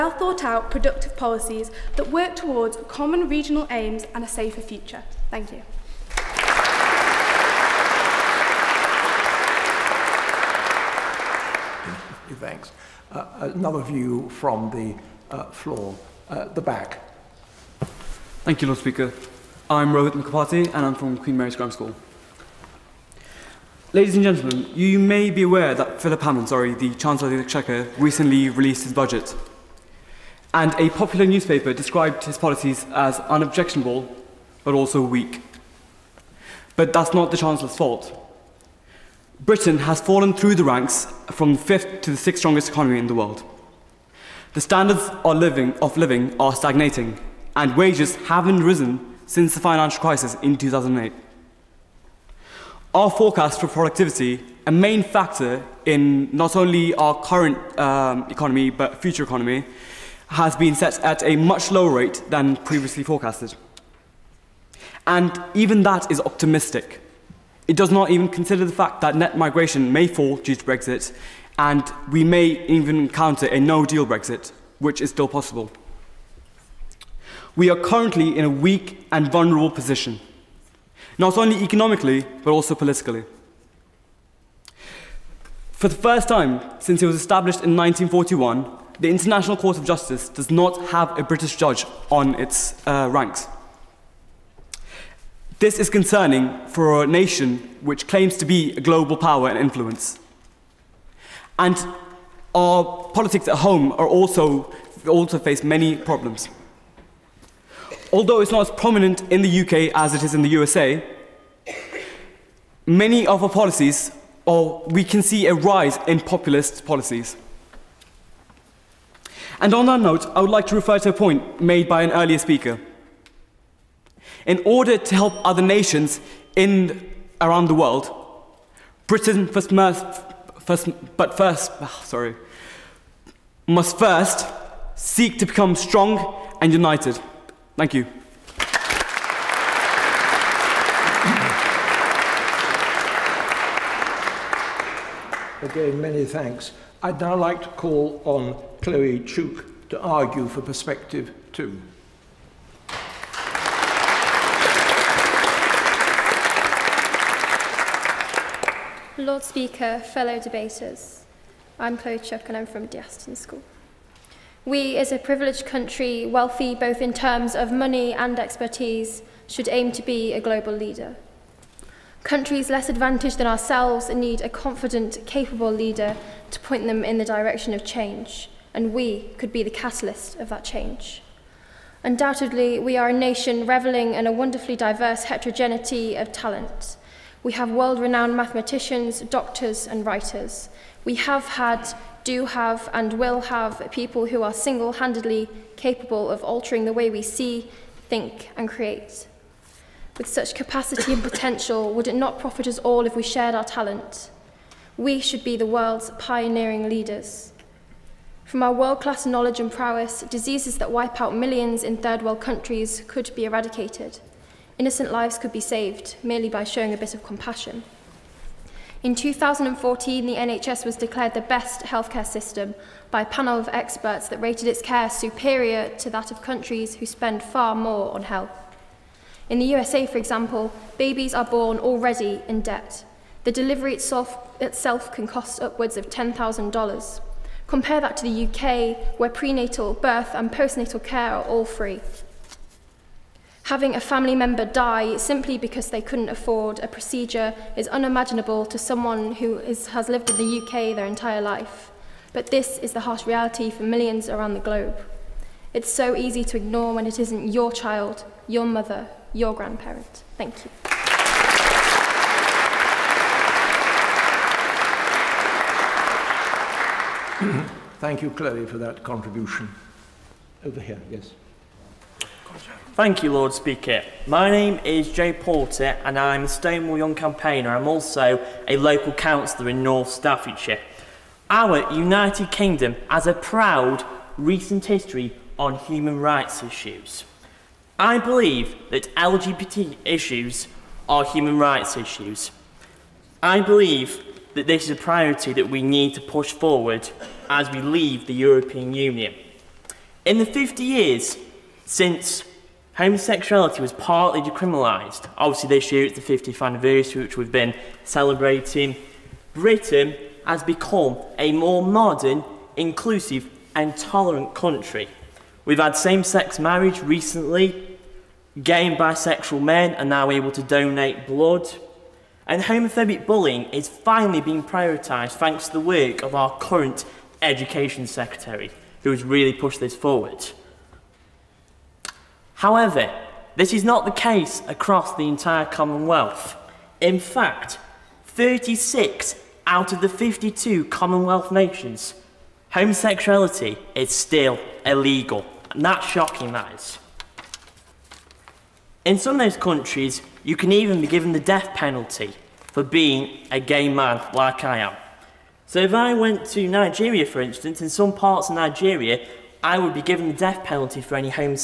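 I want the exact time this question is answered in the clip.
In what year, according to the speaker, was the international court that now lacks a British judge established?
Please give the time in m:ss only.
1:27.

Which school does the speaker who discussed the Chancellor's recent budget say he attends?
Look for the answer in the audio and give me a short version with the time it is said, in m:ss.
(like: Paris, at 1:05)
Queen Mary's Grammar School, at 0:21.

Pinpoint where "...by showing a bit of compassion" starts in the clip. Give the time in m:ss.
3:36.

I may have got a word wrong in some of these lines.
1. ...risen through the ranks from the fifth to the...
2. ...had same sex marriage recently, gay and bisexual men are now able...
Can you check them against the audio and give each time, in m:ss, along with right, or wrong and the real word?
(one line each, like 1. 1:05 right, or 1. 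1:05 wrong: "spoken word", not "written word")
1. 0:40 wrong: "fallen", not "risen"
2. 5:15 right.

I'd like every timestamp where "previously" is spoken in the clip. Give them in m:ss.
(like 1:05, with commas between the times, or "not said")
1:02.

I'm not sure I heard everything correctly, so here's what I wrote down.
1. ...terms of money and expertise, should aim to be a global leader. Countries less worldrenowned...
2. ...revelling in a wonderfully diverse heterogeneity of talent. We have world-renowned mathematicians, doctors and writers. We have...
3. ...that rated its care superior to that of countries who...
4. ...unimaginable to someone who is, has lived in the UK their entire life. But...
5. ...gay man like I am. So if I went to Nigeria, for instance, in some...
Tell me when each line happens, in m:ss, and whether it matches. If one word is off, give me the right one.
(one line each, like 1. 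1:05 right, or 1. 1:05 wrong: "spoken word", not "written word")
1. 2:47 wrong: "advantaged", not "worldrenowned"
2. 3:03 right
3. 3:44 right
4. 4:07 right
5. 5:53 right.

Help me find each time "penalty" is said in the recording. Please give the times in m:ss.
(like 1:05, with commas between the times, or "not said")
5:51, 6:00.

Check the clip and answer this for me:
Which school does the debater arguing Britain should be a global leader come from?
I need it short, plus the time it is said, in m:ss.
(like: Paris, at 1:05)
De Aston School, at 2:42.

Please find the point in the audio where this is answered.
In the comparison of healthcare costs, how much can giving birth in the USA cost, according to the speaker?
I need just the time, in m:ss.
3:55.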